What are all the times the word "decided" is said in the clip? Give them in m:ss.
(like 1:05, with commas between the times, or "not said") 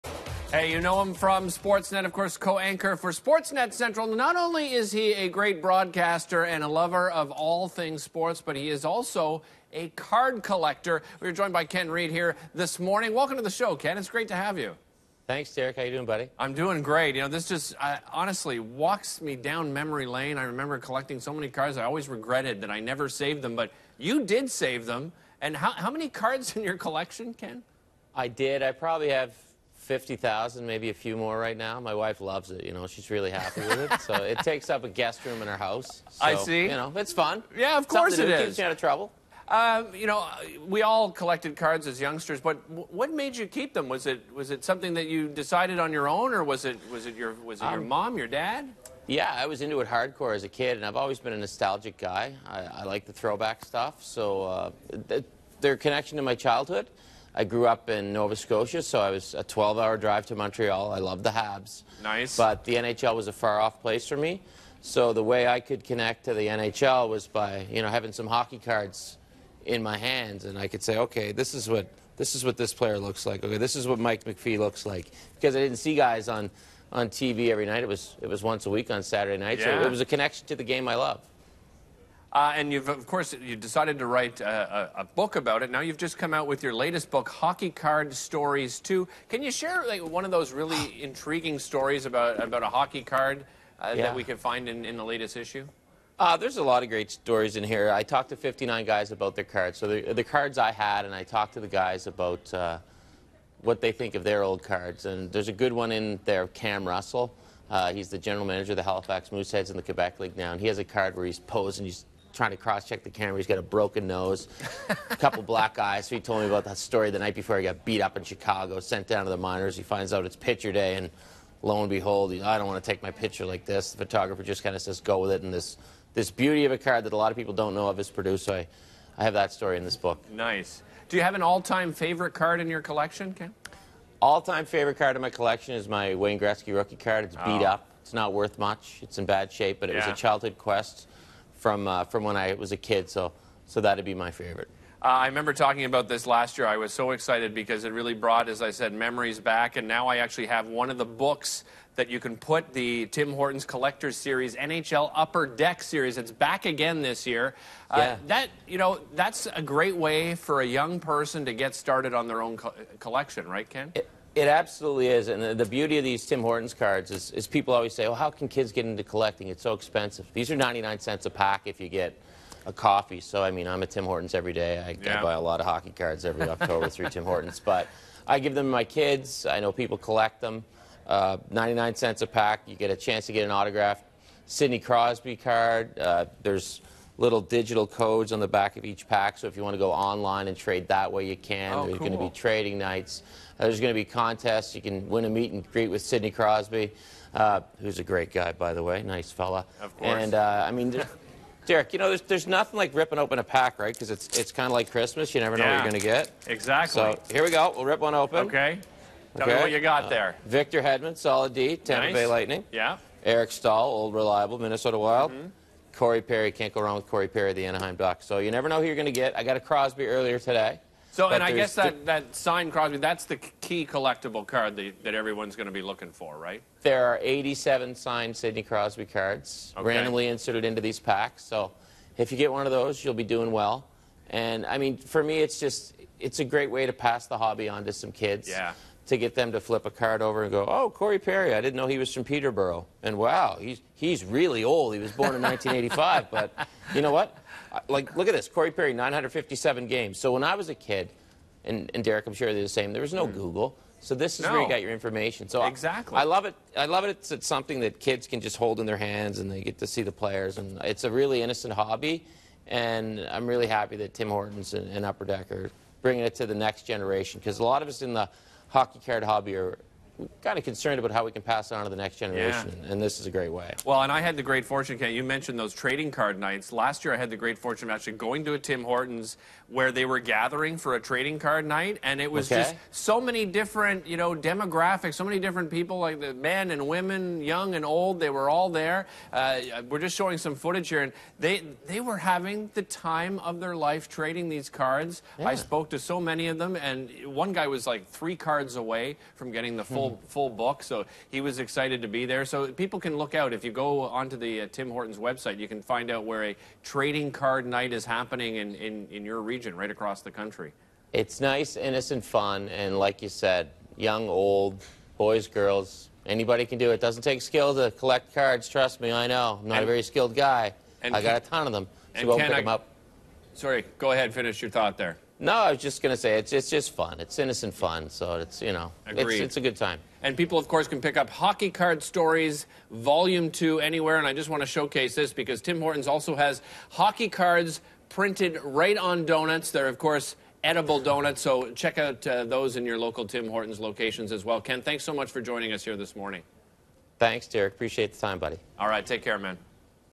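0:45, 1:23.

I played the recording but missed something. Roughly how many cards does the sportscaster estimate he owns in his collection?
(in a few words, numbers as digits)
50,000.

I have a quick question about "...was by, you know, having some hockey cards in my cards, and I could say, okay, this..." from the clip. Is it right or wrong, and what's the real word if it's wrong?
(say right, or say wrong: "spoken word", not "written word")
wrong: "hands", not "cards".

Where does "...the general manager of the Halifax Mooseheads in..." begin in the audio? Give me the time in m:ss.
1:48.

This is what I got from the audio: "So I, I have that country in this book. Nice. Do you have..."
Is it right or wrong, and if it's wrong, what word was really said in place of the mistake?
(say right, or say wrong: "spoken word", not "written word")
wrong: "story", not "country".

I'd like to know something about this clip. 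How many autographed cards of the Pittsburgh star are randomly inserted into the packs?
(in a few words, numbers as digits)
87.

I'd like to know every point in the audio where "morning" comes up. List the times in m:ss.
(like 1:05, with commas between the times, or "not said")
0:12, 5:46.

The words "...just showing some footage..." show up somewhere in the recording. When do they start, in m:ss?
4:49.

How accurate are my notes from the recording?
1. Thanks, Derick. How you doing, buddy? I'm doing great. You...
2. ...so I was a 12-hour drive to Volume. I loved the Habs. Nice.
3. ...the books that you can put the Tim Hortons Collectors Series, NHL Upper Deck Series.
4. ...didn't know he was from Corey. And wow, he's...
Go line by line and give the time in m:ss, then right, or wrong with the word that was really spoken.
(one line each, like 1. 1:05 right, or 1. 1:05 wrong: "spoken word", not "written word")
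1. 0:15 right
2. 0:58 wrong: "Montreal", not "Volume"
3. 2:30 right
4. 4:01 wrong: "Peterborough", not "Corey".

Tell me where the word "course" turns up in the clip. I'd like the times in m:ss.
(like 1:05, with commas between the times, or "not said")
0:02, 0:37, 1:23, 3:19, 5:30, 5:39.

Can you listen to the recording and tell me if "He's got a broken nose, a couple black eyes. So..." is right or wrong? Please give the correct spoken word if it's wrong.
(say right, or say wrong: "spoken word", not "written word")
right.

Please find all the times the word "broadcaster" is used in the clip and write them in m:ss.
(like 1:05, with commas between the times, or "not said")
0:05.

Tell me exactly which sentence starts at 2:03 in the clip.
The photographer just kind of says, go with it.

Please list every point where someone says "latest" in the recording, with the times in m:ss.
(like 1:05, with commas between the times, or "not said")
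1:26, 1:35.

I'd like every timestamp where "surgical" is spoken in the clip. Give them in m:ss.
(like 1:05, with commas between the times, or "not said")
not said.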